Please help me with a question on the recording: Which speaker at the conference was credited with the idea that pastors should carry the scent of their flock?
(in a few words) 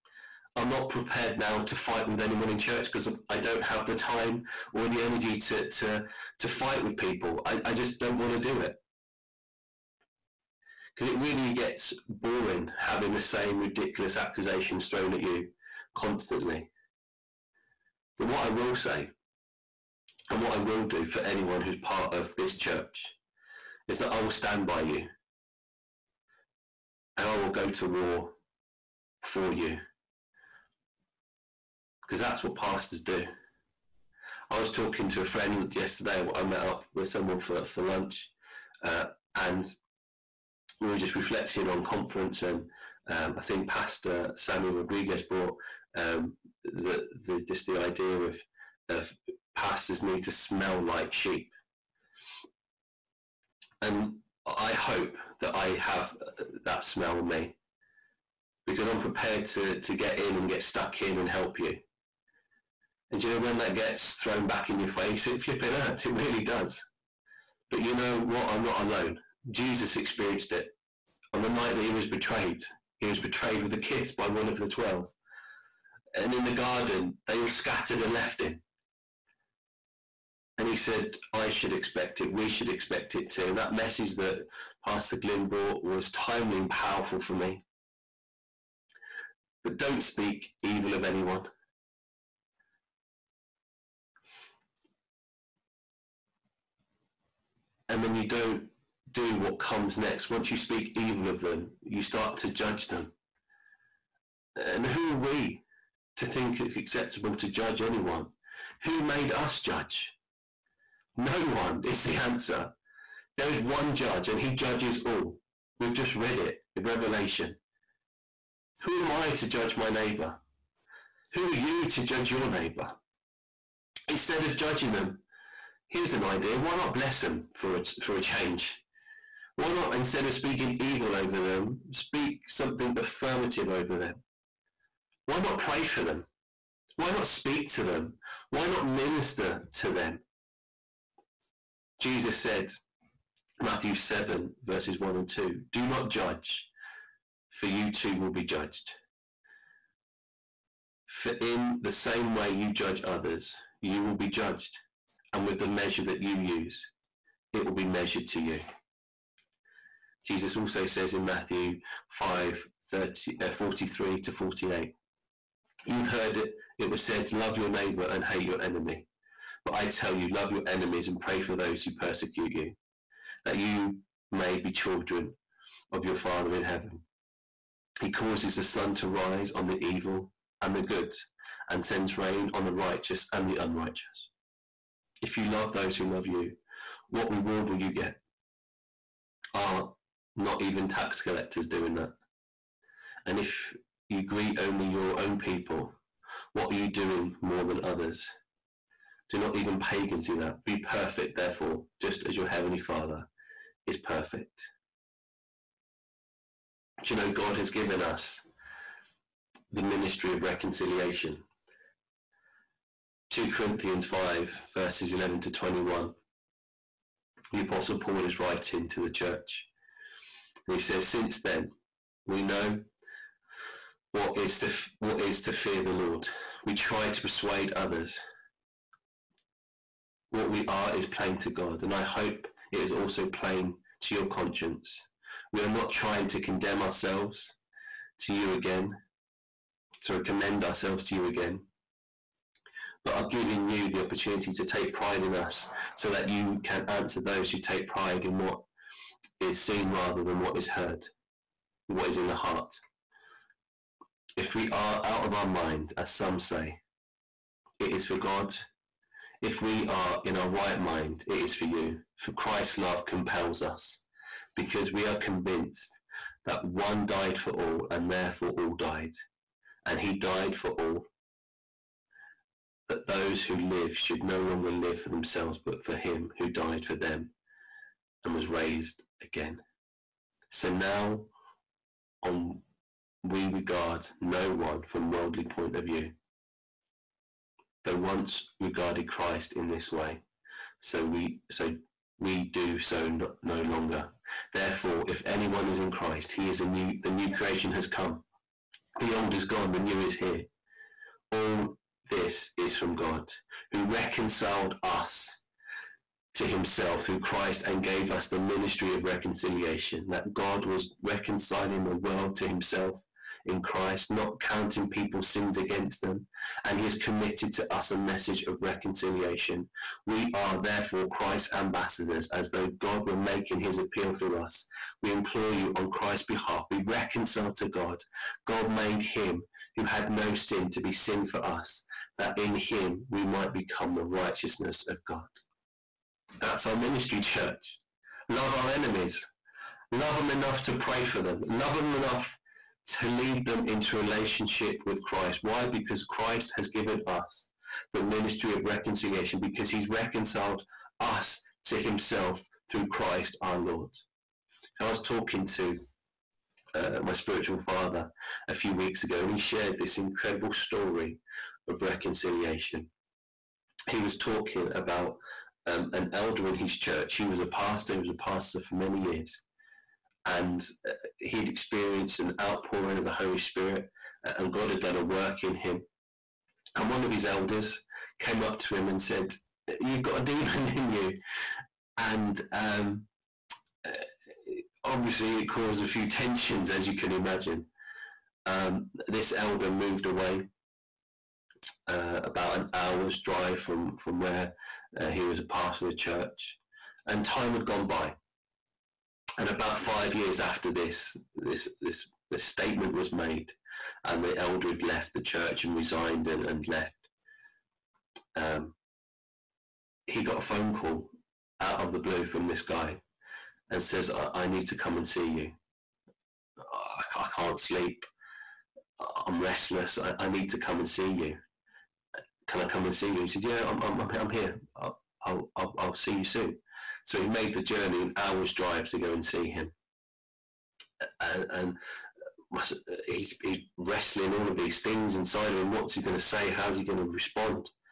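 Sammy Rodriguez.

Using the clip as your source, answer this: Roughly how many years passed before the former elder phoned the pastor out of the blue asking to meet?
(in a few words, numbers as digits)
5.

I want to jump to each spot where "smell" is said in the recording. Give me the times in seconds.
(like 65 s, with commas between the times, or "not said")
50 s, 56 s.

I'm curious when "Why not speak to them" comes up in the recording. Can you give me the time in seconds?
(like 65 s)
136 s.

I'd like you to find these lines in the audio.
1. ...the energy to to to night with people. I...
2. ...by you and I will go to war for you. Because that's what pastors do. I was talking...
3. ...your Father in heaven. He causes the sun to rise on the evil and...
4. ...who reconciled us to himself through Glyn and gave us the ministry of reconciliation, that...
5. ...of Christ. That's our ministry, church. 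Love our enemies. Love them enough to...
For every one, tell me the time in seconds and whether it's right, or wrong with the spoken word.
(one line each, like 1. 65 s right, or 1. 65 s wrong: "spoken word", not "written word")
1. 4 s wrong: "fight", not "night"
2. 24 s right
3. 176 s right
4. 303 s wrong: "Christ", not "Glyn"
5. 334 s wrong: "God", not "Christ".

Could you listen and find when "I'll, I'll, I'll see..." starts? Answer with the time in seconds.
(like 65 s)
424 s.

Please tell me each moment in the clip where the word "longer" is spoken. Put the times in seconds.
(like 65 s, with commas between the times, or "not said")
274 s, 293 s.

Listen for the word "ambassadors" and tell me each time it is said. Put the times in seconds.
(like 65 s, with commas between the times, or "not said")
321 s.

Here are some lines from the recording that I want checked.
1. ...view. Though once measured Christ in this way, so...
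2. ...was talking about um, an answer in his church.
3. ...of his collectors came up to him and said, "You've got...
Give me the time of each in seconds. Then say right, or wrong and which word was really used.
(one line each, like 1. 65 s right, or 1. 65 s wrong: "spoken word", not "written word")
1. 285 s wrong: "regarded", not "measured"
2. 363 s wrong: "elder", not "answer"
3. 377 s wrong: "elders", not "collectors".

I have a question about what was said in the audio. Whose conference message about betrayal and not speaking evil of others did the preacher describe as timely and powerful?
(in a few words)
Pastor Glyn.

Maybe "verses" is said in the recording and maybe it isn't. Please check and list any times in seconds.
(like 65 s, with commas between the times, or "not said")
144 s, 214 s.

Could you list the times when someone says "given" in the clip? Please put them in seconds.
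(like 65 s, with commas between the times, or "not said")
207 s, 346 s.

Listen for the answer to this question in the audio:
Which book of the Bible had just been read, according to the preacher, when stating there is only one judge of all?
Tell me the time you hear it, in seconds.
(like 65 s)
116 s.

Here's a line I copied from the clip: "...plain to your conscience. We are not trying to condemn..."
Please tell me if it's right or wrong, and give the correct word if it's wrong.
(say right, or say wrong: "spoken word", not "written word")
right.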